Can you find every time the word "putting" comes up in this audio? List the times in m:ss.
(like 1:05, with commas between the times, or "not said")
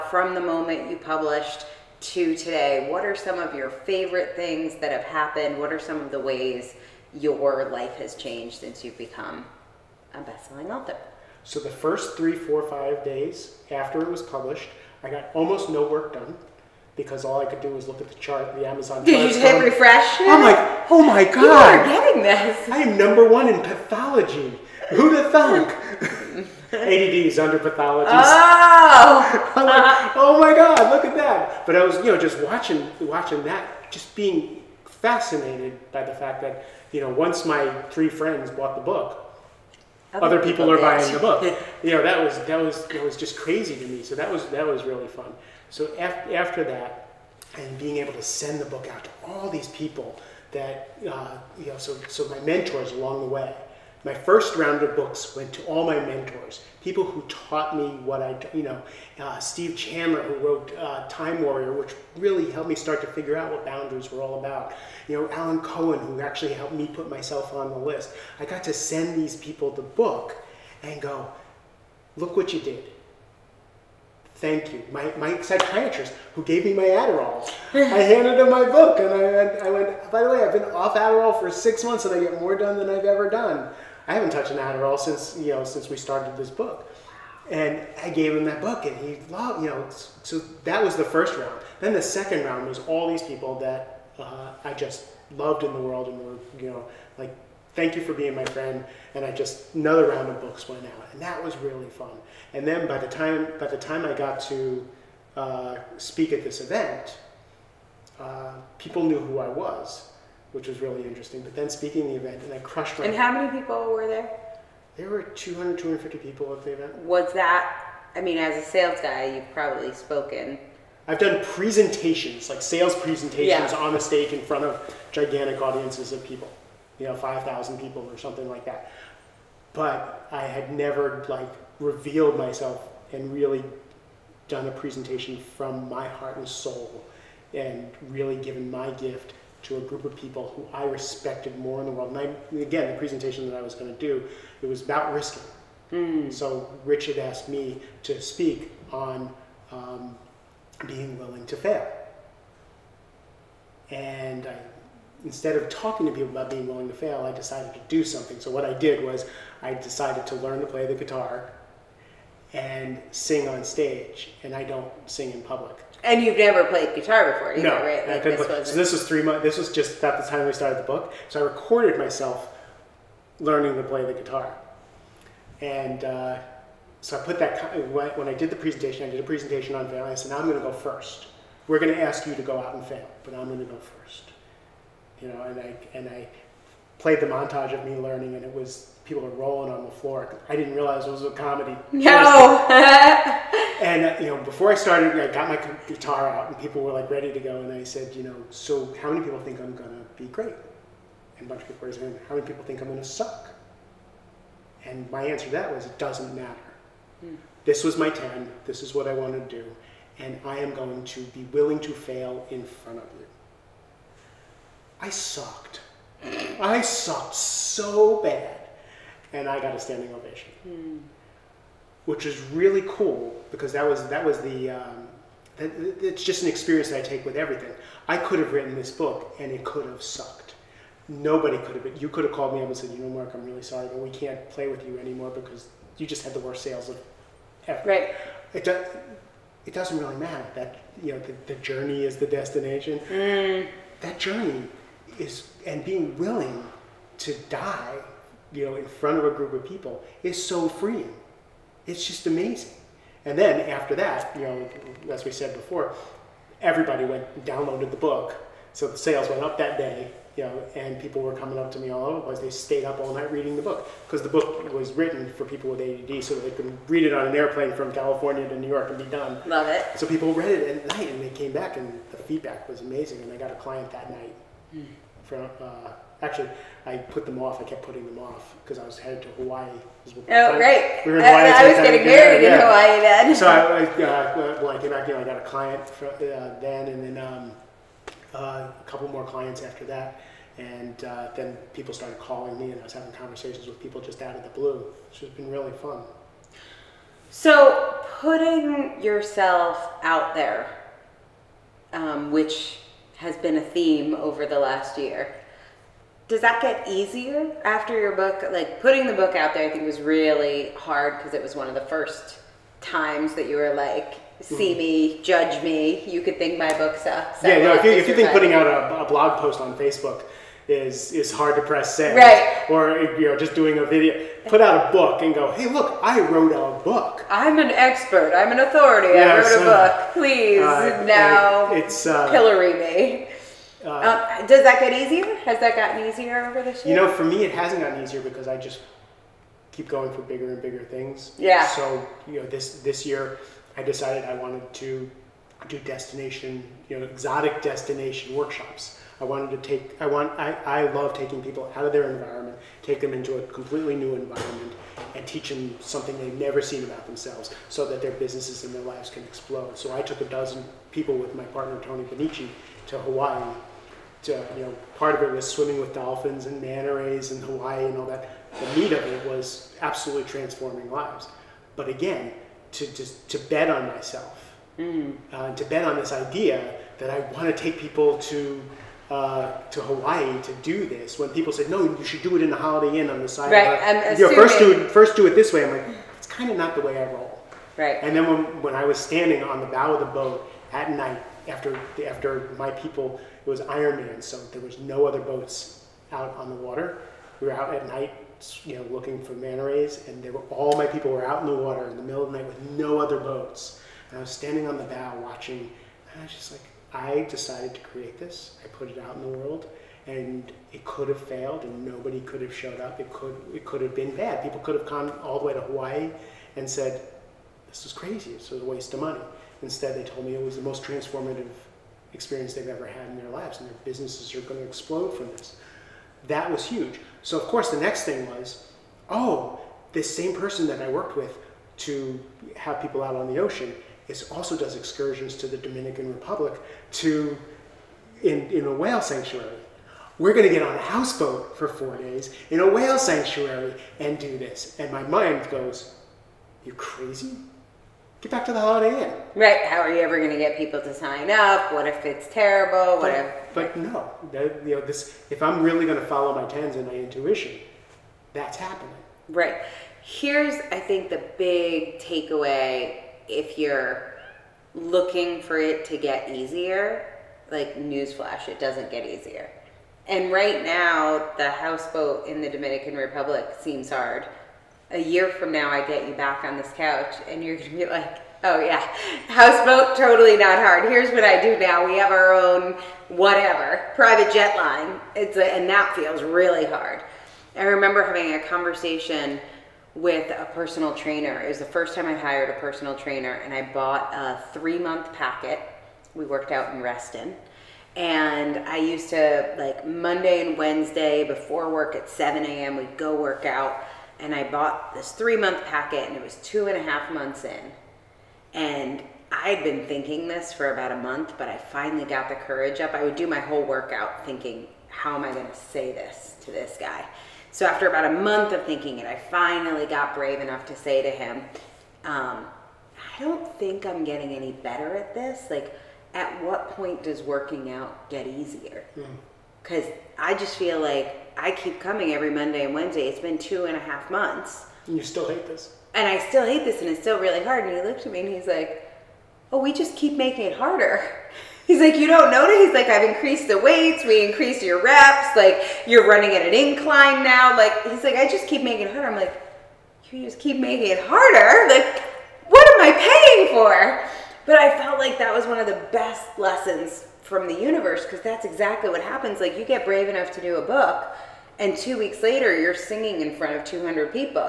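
4:37, 4:58, 5:08, 5:18.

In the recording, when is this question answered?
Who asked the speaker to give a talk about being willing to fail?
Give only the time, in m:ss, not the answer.
2:26.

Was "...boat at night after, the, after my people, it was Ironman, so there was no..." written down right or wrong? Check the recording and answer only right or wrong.
right.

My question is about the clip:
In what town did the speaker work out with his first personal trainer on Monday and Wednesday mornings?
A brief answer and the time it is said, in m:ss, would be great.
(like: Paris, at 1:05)
Reston, at 8:16.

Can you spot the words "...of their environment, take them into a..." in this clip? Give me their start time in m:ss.
5:51.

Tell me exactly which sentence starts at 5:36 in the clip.
You know, for me, it hasn't gotten easier because I just keep going for bigger and bigger things.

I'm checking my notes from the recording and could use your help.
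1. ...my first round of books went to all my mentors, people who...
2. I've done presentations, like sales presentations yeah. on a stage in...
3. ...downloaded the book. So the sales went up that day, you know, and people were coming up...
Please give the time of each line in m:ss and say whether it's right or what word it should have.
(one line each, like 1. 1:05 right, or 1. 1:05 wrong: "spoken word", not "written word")
1. 0:54 right
2. 2:01 right
3. 4:17 right.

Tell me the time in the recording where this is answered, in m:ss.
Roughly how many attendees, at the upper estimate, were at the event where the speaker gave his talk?
1:55.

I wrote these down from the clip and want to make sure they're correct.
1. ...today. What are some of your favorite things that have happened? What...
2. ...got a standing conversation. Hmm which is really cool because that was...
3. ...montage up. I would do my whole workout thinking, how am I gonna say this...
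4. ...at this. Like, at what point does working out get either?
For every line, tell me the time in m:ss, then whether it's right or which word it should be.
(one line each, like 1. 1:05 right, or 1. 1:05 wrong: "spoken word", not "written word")
1. 0:02 right
2. 3:39 wrong: "ovation", not "conversation"
3. 8:32 wrong: "courage", not "montage"
4. 8:44 wrong: "easier", not "either".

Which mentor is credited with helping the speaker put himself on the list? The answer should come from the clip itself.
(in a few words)
Alan Cohen.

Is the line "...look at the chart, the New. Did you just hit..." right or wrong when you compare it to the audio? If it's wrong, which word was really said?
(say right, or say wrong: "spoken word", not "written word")
wrong: "Amazon", not "New".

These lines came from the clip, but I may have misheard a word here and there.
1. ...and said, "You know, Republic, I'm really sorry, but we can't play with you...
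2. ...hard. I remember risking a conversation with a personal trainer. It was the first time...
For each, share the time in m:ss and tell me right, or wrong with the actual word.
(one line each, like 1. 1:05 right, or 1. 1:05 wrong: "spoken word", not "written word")
1. 3:52 wrong: "Mark", not "Republic"
2. 8:06 wrong: "having", not "risking".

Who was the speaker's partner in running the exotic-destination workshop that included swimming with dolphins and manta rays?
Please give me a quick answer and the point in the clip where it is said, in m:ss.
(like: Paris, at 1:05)
Tony Benici, at 6:01.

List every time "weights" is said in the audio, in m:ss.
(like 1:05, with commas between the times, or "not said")
9:03.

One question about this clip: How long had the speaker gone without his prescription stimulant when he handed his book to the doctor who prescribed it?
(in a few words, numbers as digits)
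6 months.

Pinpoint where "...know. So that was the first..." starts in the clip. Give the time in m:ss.
1:29.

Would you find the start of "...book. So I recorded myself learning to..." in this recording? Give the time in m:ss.
2:50.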